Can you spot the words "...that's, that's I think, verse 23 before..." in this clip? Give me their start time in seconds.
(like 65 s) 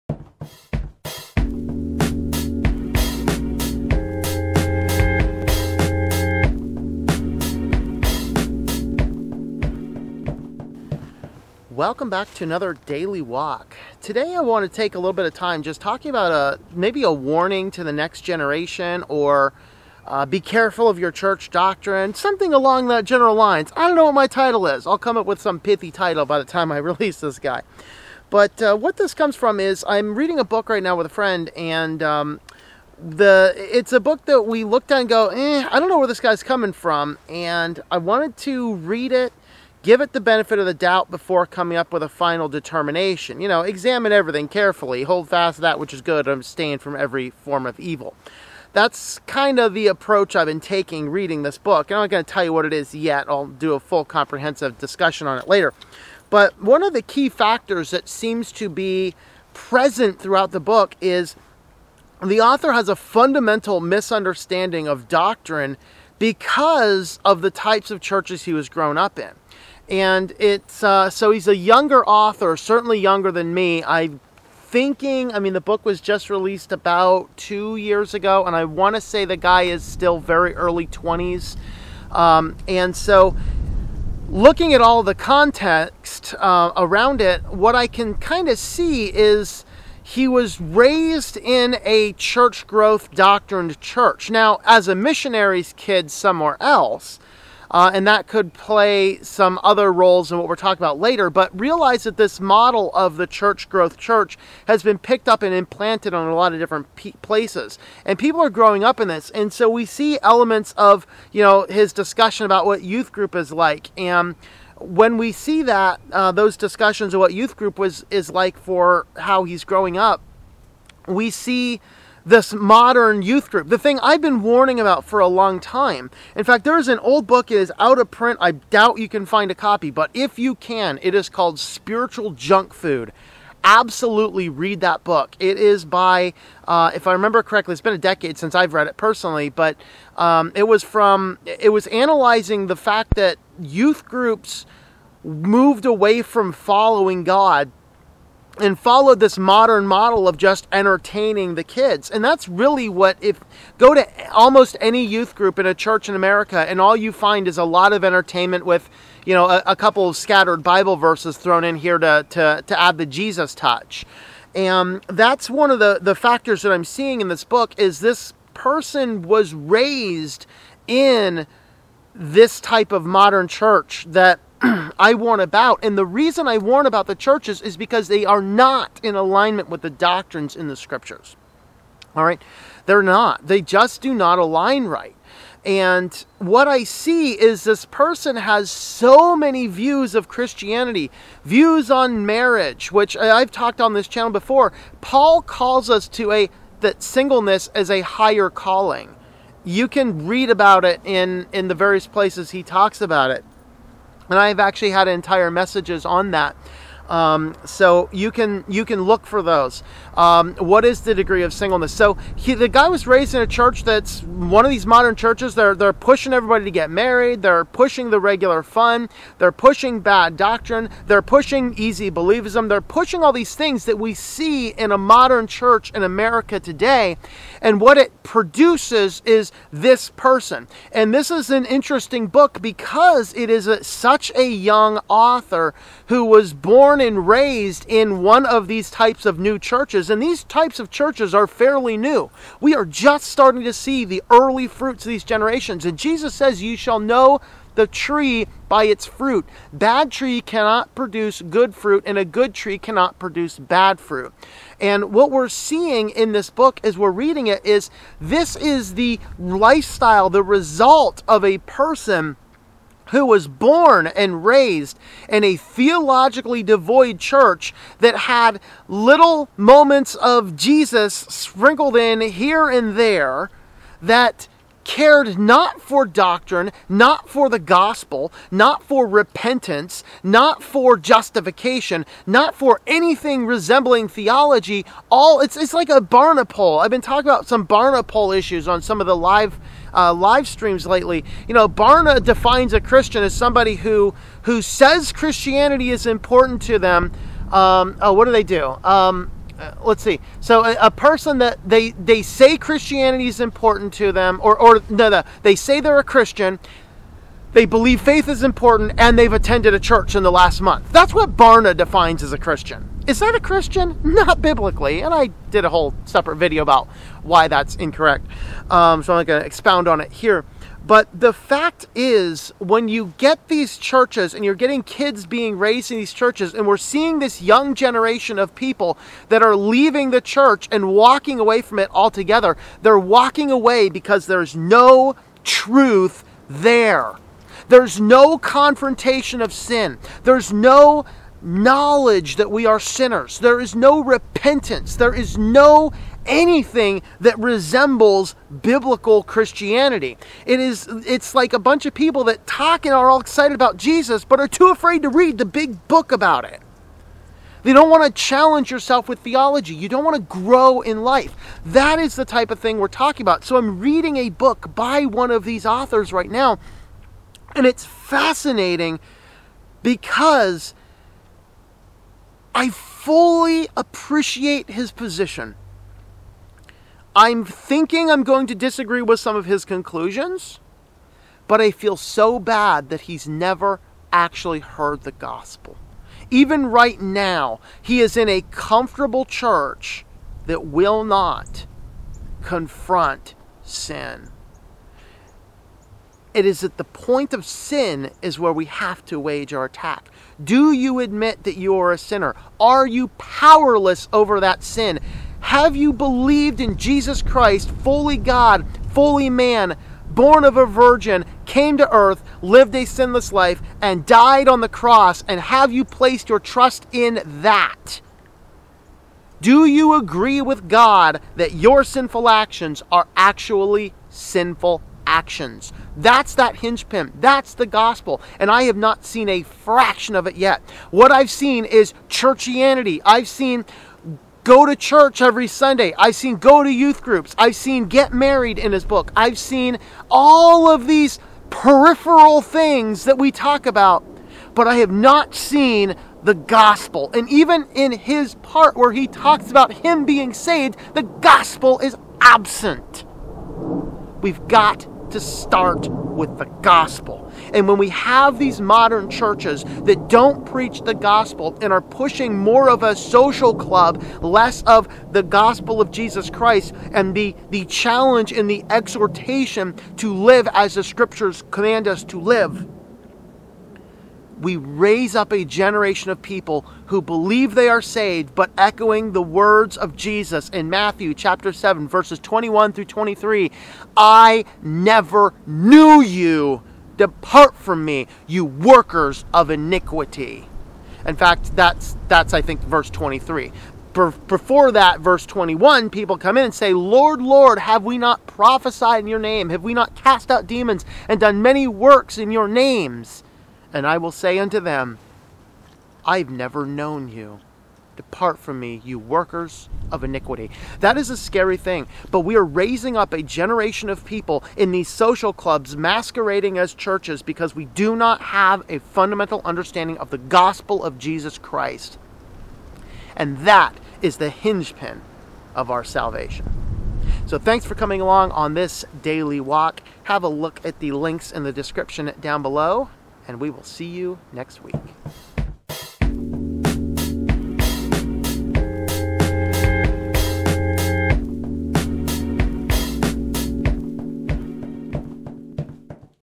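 491 s.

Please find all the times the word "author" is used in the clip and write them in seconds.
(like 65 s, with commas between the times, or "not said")
62 s, 72 s, 235 s, 365 s.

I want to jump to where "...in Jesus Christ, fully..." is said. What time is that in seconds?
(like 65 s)
406 s.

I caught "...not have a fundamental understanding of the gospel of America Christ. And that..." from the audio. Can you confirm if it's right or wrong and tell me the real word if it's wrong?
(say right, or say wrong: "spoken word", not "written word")
wrong: "Jesus", not "America".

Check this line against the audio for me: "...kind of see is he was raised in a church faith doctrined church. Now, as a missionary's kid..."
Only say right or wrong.
wrong.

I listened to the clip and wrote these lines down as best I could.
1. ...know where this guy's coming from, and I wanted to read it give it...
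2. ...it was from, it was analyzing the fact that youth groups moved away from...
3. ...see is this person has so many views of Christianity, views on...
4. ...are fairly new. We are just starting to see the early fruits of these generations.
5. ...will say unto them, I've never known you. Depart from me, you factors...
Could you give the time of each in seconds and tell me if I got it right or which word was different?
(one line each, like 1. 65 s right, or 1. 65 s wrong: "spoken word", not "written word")
1. 35 s right
2. 140 s right
3. 186 s right
4. 241 s right
5. 503 s wrong: "workers", not "factors".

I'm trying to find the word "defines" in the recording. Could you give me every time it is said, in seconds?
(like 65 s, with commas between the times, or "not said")
292 s, 311 s.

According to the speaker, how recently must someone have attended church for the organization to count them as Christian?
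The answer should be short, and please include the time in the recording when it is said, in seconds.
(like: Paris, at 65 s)
The last month, at 310 s.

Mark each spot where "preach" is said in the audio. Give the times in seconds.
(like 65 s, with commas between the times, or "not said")
460 s.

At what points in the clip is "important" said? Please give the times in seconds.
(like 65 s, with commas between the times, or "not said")
296 s, 303 s, 308 s.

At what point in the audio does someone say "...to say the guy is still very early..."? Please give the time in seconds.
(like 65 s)
78 s.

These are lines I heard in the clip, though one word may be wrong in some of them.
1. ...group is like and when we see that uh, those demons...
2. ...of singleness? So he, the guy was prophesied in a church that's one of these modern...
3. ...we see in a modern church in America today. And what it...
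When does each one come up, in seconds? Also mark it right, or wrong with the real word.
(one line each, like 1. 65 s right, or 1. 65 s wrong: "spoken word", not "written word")
1. 113 s wrong: "discussions", not "demons"
2. 211 s wrong: "raised", not "prophesied"
3. 223 s right.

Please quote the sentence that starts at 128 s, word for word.
I doubt you can find a copy, but if you can, it is called Spiritual Junk Food absolutely read that book.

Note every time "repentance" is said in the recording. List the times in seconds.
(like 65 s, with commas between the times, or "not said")
279 s, 344 s.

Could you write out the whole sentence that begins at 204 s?
And I've actually had entire messages on that.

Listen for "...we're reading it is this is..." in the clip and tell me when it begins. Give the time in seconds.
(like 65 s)
256 s.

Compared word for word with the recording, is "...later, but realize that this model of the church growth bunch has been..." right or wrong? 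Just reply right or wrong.
wrong.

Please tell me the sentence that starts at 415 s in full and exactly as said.
And have you placed your trust in that?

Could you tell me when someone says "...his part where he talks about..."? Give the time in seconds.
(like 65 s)
447 s.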